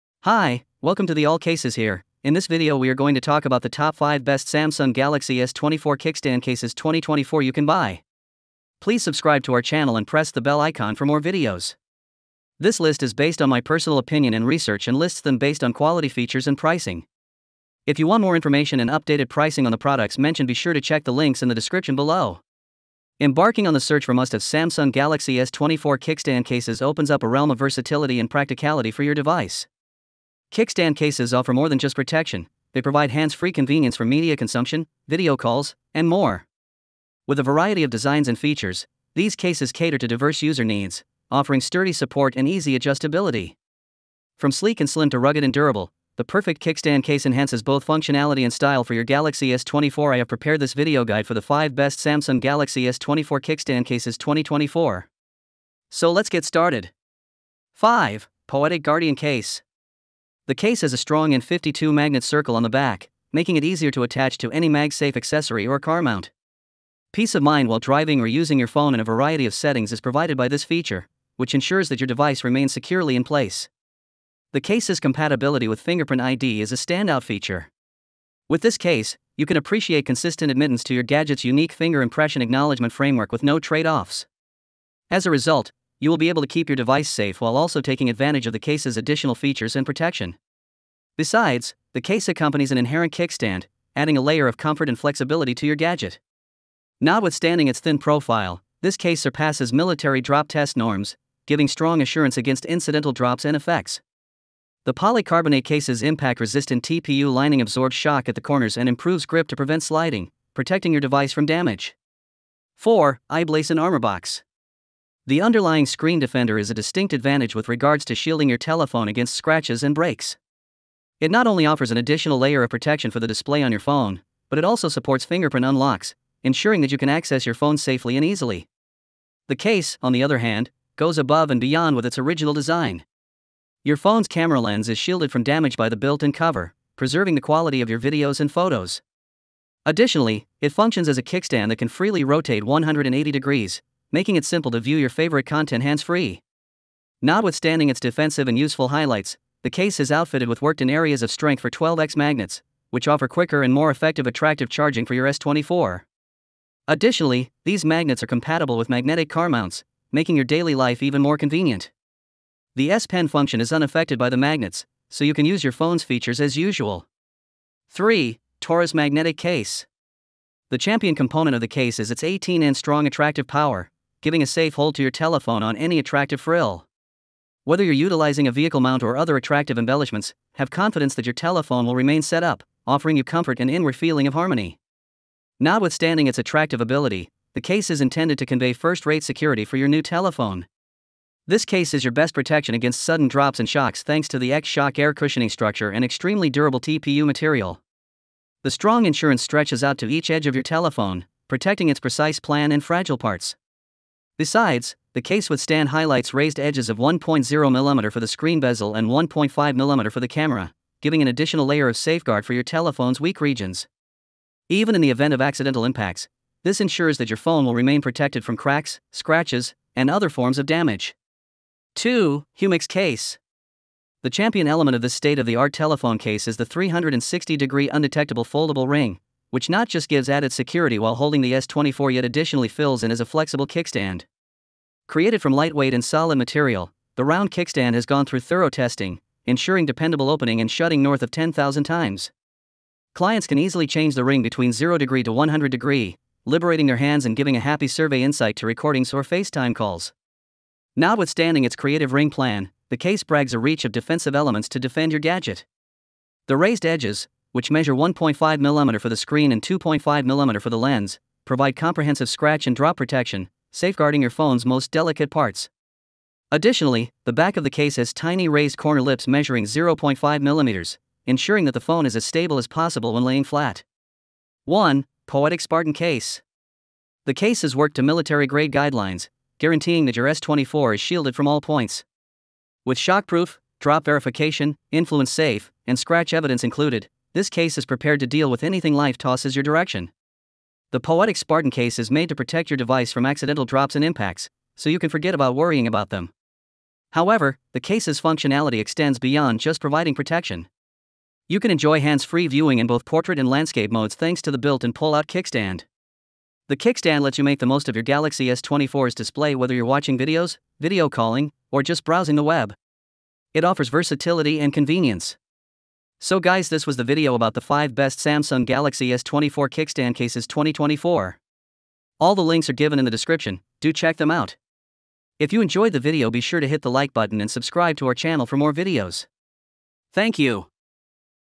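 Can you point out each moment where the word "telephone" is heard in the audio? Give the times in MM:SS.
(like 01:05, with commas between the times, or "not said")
01:58, 02:55, 03:01, 03:10, 03:20, 03:32, 03:45.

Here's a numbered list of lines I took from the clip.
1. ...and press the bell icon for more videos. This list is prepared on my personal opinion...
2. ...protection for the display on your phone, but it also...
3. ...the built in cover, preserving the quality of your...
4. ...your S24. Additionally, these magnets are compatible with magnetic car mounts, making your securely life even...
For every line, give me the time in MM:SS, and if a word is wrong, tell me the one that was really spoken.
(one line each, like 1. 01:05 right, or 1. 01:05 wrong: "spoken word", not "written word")
1. 00:09 wrong: "based", not "prepared"
2. 02:02 right
3. 02:15 right
4. 02:35 wrong: "daily", not "securely".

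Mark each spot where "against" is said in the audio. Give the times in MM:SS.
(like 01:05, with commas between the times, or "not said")
01:42, 01:59, 03:12.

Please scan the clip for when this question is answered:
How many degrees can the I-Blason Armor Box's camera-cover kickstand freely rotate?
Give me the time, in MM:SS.
02:22.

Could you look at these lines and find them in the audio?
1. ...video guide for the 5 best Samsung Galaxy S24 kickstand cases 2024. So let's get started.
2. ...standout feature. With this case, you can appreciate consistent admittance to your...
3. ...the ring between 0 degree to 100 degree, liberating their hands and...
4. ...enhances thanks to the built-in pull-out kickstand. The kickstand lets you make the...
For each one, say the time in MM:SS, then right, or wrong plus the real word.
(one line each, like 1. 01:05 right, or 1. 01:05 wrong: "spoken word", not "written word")
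1. 00:50 right
2. 01:16 right
3. 04:04 right
4. 05:03 wrong: "modes", not "enhances".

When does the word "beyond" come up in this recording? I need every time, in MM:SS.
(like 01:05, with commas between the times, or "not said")
02:11, 04:59.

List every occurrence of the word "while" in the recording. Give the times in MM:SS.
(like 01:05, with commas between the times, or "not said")
01:07, 01:27, 03:50.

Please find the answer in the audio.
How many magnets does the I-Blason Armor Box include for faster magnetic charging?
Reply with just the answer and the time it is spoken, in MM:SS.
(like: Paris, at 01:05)
12x, at 02:31.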